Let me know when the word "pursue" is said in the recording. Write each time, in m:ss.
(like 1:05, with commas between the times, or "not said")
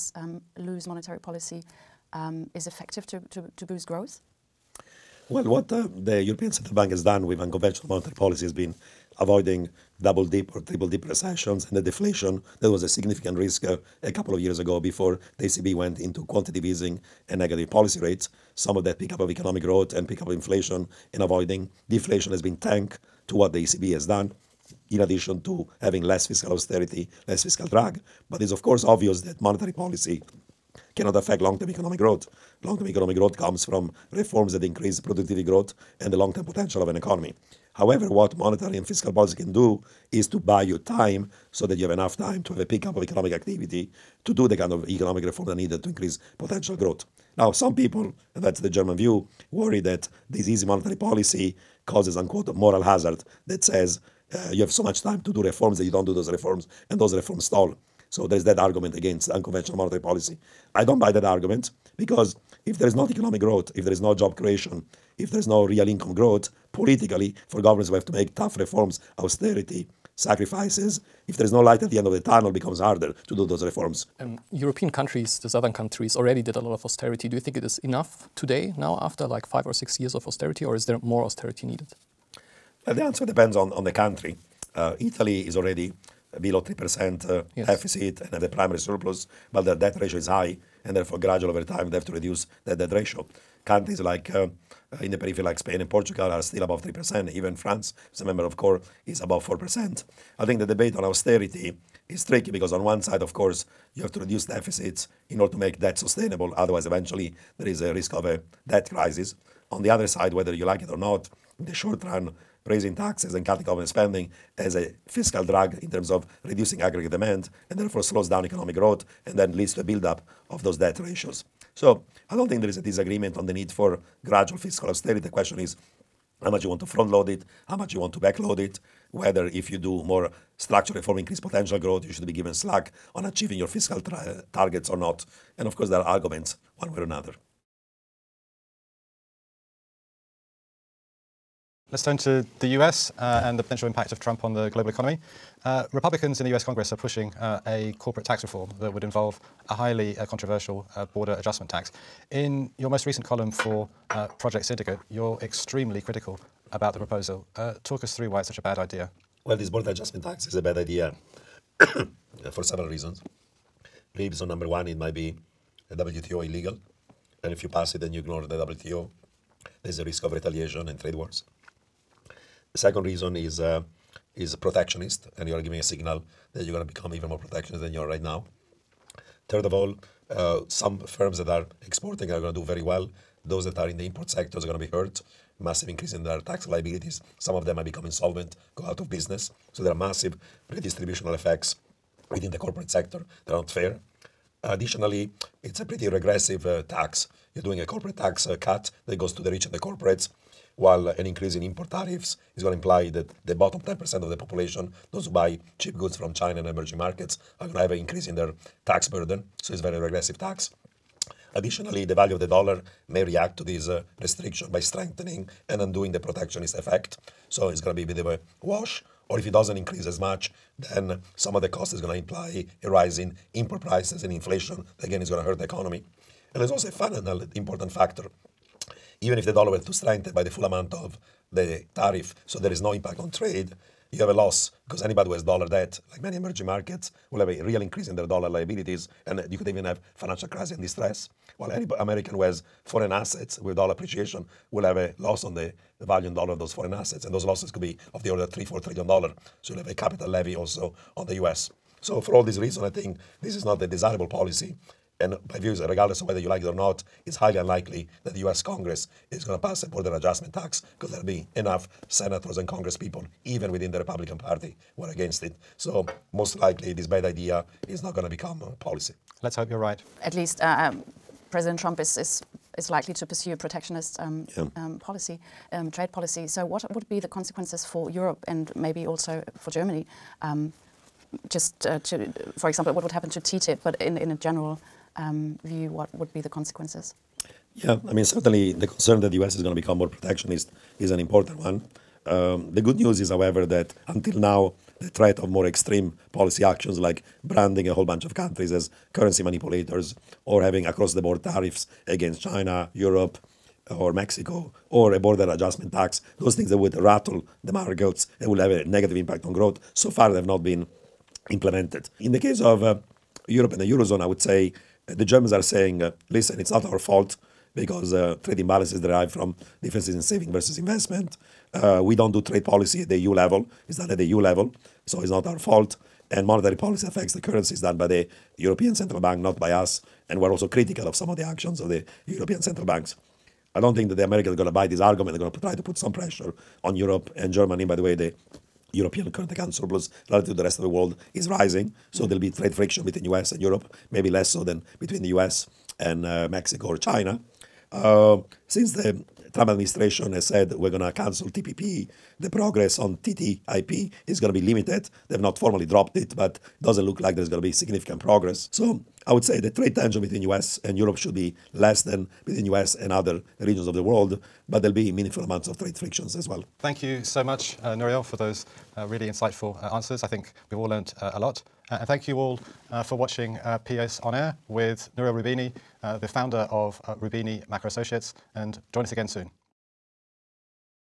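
4:33.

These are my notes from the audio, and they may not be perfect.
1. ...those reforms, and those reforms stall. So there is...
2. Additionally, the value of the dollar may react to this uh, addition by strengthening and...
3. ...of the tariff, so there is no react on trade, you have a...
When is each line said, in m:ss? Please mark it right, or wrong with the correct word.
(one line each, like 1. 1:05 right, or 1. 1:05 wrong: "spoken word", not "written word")
1. 0:56 right
2. 3:31 wrong: "restriction", not "addition"
3. 3:50 wrong: "impact", not "react".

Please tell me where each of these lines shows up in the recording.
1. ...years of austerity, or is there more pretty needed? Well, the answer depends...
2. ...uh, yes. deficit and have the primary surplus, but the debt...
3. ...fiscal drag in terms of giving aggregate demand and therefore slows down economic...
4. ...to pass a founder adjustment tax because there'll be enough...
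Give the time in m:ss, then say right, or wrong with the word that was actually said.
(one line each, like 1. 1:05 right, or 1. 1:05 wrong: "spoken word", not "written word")
1. 1:19 wrong: "austerity", not "pretty"
2. 1:27 right
3. 1:55 wrong: "reducing", not "giving"
4. 4:19 wrong: "border", not "founder".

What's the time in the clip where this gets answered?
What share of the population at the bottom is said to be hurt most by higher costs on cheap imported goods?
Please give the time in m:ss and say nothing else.
3:23.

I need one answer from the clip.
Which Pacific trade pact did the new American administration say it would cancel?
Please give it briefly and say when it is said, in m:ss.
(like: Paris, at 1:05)
TPP, at 5:51.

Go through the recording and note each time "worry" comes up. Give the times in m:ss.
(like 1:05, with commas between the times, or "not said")
0:49.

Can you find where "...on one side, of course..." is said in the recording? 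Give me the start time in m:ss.
1:42.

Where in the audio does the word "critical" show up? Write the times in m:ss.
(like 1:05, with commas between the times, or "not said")
2:36, 5:30.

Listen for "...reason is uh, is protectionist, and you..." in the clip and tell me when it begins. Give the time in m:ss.
2:53.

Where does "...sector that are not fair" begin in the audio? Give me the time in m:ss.
3:12.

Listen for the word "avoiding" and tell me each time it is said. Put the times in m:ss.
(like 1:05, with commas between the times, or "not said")
0:09, 0:21.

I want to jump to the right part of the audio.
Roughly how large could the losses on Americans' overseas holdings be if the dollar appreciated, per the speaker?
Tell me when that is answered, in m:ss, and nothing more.
4:08.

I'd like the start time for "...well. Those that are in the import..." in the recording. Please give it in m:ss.
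3:02.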